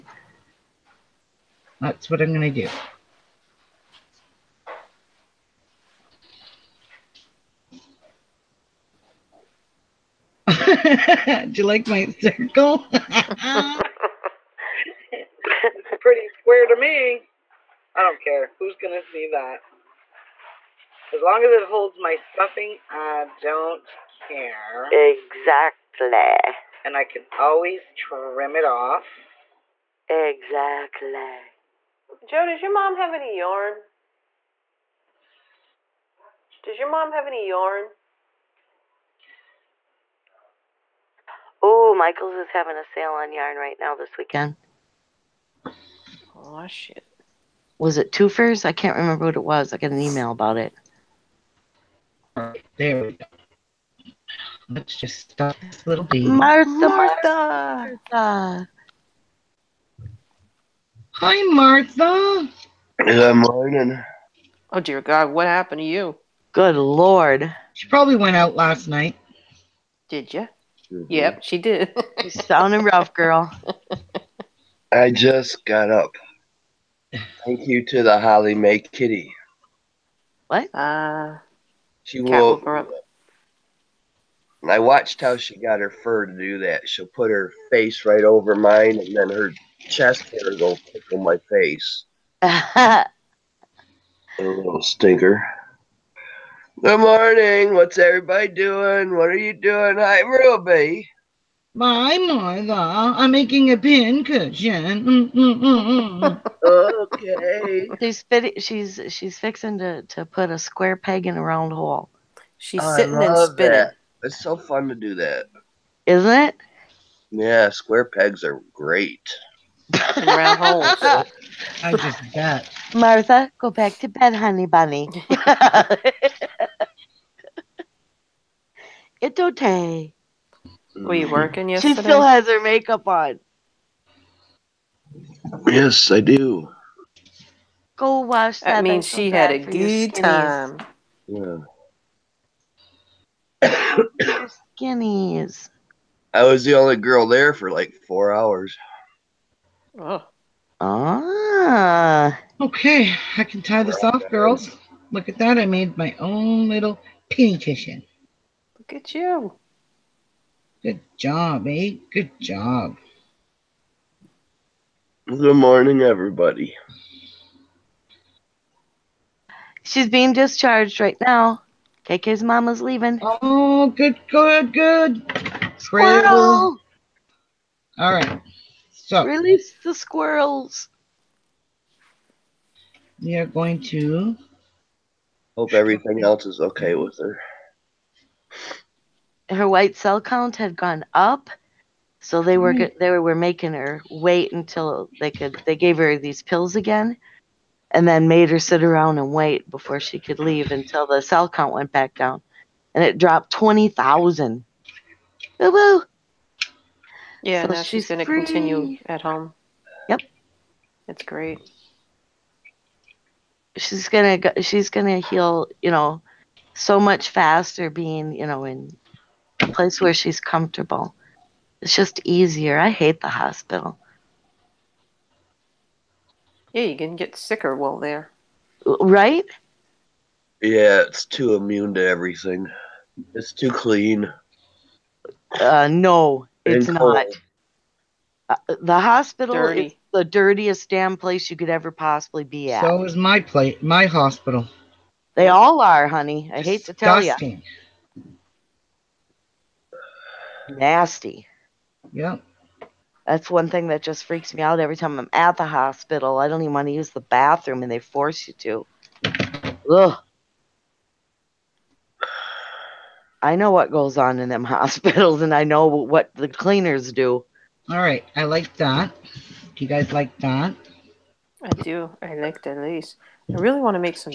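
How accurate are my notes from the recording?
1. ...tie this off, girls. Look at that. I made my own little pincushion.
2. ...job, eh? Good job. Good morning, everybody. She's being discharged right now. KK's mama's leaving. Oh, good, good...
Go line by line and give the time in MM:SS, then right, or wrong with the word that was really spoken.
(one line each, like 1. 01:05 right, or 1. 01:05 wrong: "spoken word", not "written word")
1. 02:33 right
2. 02:41 right.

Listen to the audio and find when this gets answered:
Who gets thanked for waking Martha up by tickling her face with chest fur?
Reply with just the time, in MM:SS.
01:18.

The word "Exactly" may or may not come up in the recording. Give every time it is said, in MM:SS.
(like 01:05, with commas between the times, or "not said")
00:24, 00:30.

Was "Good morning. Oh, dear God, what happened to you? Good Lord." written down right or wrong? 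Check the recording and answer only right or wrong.
right.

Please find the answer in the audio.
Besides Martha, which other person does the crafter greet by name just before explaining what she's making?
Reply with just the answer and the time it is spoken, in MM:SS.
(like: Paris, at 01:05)
Ruby, at 01:40.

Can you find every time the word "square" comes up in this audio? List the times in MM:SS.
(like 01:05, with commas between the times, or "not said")
00:16, 01:50, 01:57.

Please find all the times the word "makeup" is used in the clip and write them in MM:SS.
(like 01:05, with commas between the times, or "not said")
02:12.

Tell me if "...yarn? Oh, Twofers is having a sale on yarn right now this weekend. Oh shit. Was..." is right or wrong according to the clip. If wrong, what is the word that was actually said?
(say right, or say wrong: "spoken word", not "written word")
wrong: "Michaels", not "Twofers".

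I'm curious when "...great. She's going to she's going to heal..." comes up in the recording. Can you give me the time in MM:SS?
03:31.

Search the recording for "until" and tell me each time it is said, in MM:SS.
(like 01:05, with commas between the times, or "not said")
03:14, 03:20.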